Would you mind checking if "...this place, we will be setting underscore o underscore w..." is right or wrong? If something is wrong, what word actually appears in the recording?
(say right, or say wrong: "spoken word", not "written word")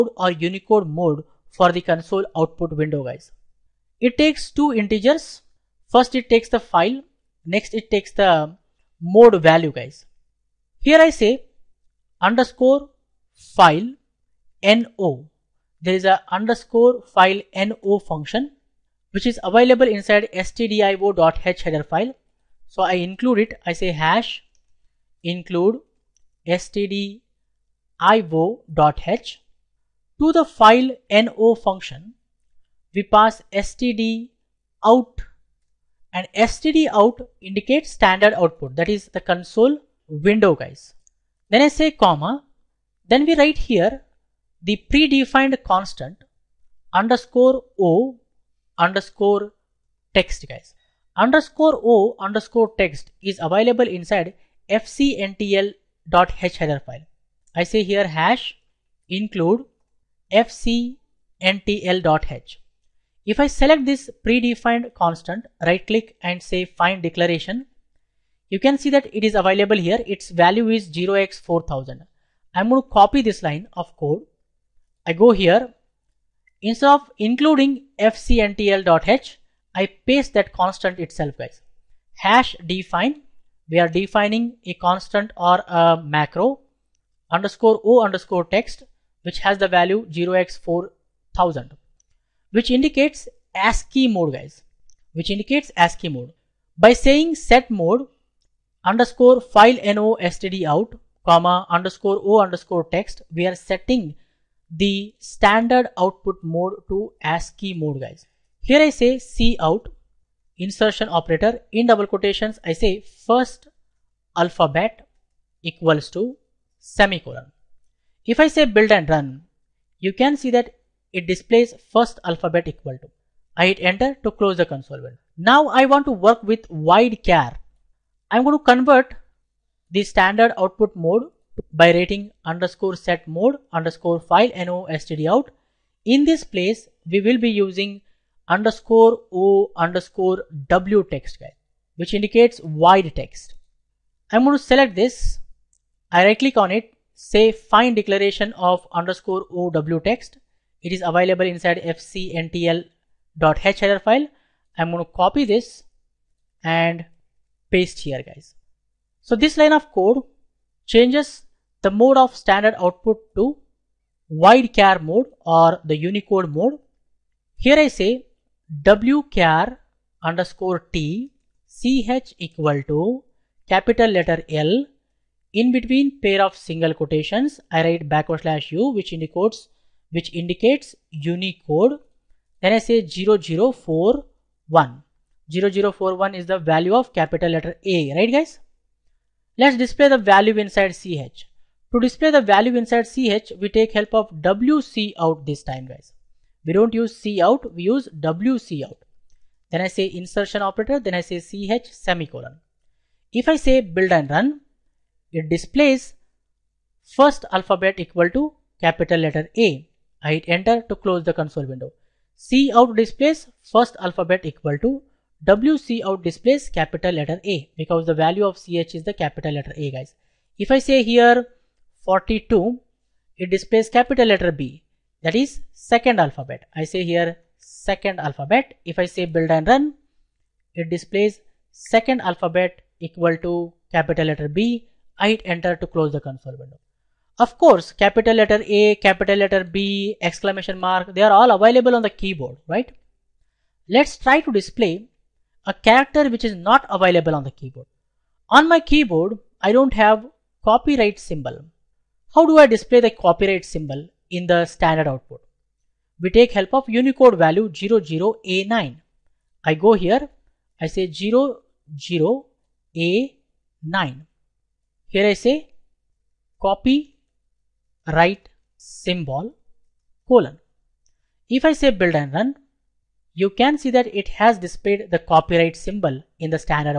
wrong: "using", not "setting".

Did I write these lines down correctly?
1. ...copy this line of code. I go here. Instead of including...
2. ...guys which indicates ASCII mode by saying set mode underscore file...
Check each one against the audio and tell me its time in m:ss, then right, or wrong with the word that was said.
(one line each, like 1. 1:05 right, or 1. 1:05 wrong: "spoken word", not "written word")
1. 1:12 right
2. 1:34 right.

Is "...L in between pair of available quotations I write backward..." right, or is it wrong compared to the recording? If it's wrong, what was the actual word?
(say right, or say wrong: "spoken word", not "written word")
wrong: "single", not "available".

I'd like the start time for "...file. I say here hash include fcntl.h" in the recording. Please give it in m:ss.
0:56.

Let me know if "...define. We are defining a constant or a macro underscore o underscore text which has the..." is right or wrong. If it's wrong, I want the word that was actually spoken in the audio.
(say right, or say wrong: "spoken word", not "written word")
right.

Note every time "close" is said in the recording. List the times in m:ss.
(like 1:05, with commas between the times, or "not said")
2:04, 3:30, 3:55.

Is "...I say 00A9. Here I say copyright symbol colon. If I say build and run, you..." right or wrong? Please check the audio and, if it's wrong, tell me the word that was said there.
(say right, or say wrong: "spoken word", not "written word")
right.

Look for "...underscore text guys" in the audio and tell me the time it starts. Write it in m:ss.
0:48.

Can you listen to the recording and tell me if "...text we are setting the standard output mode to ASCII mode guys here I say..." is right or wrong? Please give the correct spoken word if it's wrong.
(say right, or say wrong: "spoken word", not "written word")
right.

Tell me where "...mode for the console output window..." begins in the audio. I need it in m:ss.
0:00.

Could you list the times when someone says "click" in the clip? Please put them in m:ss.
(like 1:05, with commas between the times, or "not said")
1:05, 2:26.